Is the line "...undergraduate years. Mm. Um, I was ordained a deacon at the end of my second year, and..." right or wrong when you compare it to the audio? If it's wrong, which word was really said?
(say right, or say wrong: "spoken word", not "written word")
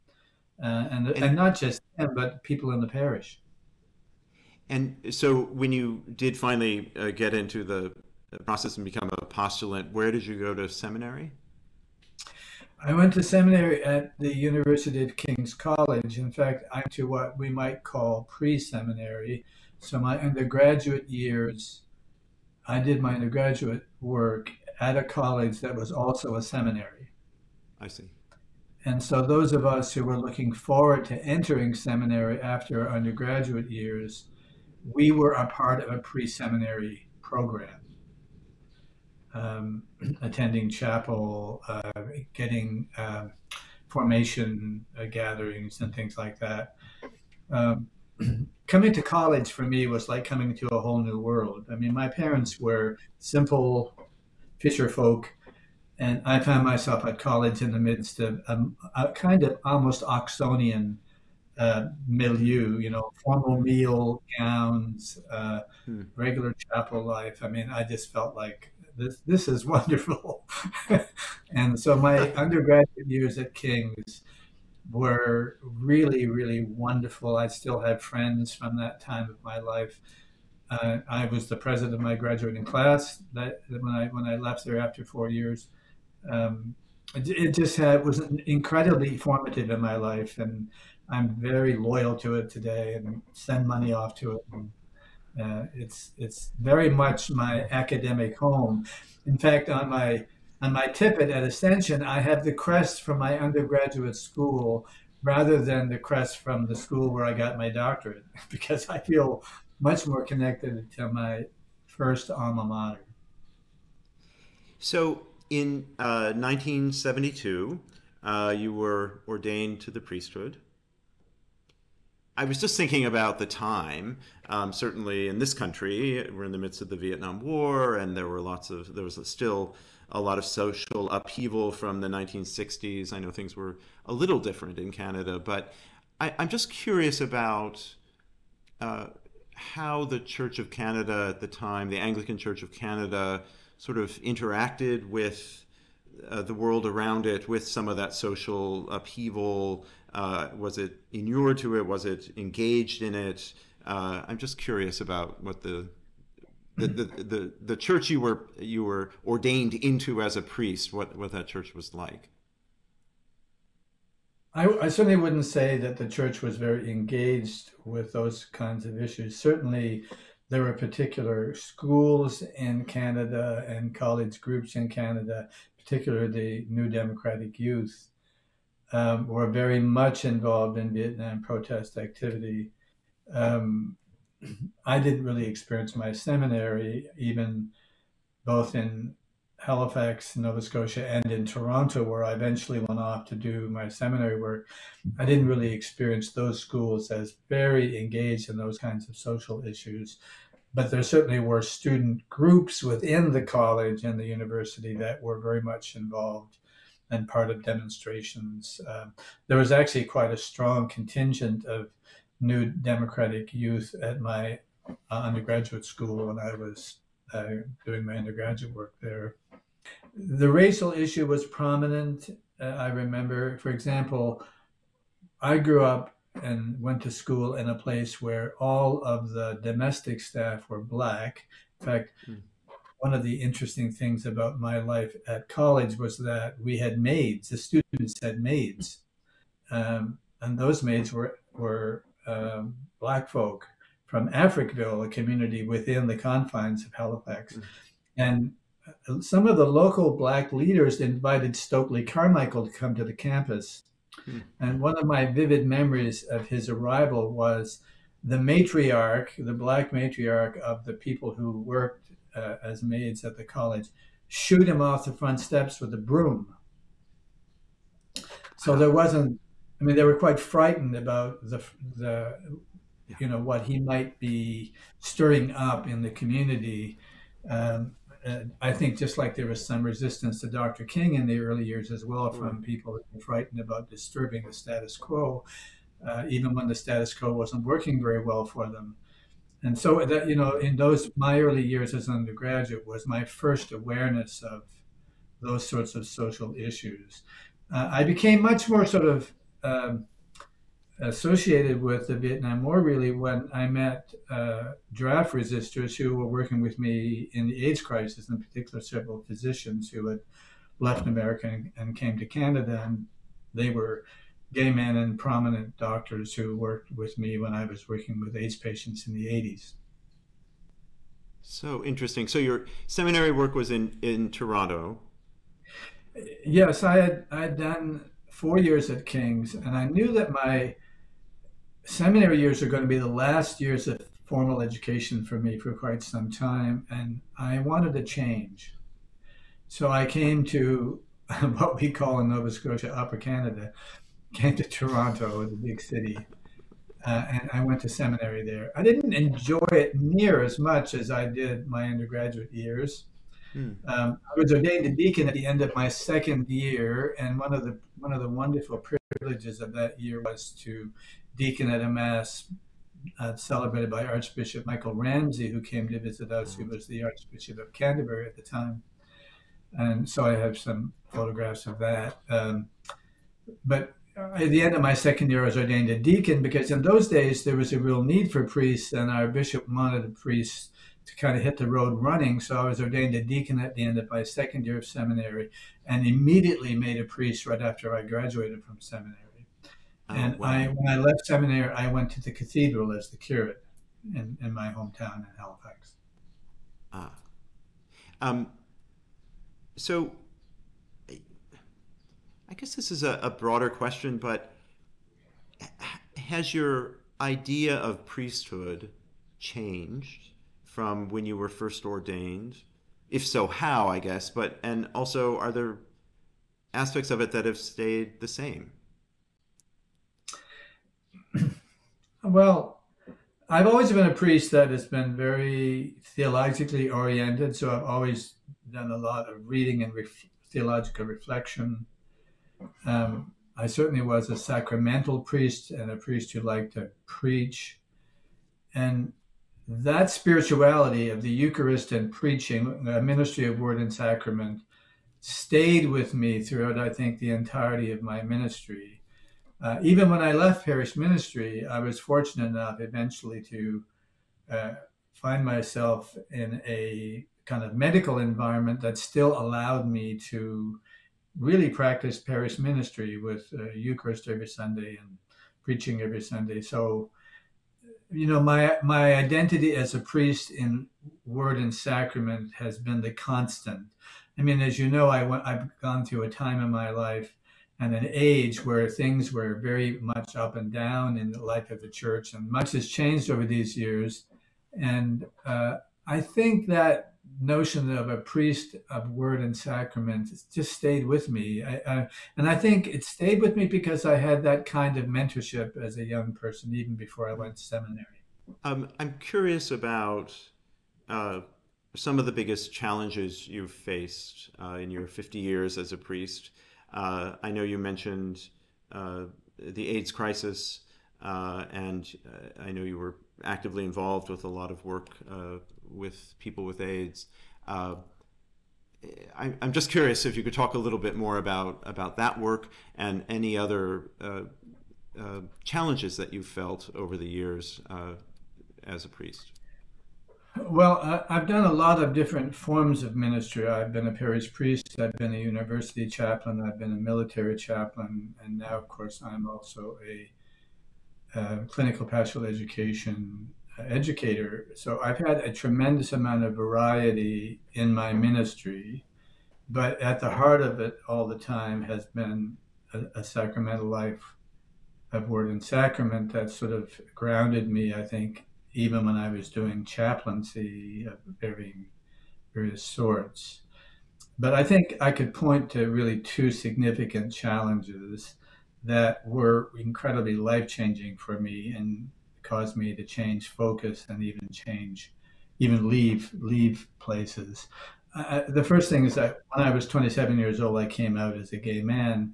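right.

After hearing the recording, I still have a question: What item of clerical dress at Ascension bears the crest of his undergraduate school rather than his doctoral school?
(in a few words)
Tippet.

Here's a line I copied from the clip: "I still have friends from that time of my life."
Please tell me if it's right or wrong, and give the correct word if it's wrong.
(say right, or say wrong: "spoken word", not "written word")
right.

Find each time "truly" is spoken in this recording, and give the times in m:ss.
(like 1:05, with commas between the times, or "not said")
not said.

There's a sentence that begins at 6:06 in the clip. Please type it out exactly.
was the Archbishop of Canterbury at the time.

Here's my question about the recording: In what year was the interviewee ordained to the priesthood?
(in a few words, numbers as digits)
1972.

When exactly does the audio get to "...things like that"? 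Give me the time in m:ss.
0:45.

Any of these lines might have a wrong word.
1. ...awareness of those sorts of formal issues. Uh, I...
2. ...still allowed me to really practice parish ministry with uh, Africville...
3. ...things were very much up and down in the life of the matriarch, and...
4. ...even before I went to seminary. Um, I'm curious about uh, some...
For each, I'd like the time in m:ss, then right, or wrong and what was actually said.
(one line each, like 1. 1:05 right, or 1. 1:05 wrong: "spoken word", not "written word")
1. 4:53 wrong: "social", not "formal"
2. 7:38 wrong: "Eucharist", not "Africville"
3. 7:58 wrong: "church", not "matriarch"
4. 8:16 right.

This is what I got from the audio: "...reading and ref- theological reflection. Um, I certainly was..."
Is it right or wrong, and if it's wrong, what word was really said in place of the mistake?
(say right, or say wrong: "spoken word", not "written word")
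right.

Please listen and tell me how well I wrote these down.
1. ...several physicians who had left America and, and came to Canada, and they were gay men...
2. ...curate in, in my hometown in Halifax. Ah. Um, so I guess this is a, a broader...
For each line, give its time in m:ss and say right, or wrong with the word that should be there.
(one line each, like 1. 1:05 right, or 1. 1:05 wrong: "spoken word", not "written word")
1. 5:08 right
2. 6:33 right.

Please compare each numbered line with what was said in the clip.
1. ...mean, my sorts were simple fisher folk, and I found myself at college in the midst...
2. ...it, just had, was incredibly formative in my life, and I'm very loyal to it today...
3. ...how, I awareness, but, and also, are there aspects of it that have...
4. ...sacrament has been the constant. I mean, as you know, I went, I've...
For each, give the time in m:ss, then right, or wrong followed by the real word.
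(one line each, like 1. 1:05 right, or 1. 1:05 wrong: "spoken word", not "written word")
1. 0:51 wrong: "parents", not "sorts"
2. 1:27 right
3. 6:53 wrong: "guess", not "awareness"
4. 7:51 right.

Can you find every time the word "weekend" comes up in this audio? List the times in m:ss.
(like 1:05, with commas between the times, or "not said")
not said.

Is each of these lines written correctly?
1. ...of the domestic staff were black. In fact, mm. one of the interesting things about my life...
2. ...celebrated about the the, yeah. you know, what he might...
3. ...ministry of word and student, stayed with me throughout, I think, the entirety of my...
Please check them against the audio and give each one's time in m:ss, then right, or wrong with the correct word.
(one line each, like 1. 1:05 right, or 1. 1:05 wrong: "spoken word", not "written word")
1. 3:49 right
2. 4:30 wrong: "frightened", not "celebrated"
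3. 7:23 wrong: "sacrament", not "student".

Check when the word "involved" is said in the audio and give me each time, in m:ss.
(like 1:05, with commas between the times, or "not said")
3:00, 3:25, 8:33.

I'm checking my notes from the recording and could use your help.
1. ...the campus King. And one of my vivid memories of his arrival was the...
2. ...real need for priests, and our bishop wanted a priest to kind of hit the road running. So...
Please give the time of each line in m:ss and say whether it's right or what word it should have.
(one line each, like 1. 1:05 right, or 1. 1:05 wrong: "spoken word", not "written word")
1. 4:13 wrong: "Hmm", not "King"
2. 6:17 right.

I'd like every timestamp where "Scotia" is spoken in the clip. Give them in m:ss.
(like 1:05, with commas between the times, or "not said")
3:10, 5:42.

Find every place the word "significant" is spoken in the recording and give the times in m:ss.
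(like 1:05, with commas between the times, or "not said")
9:26.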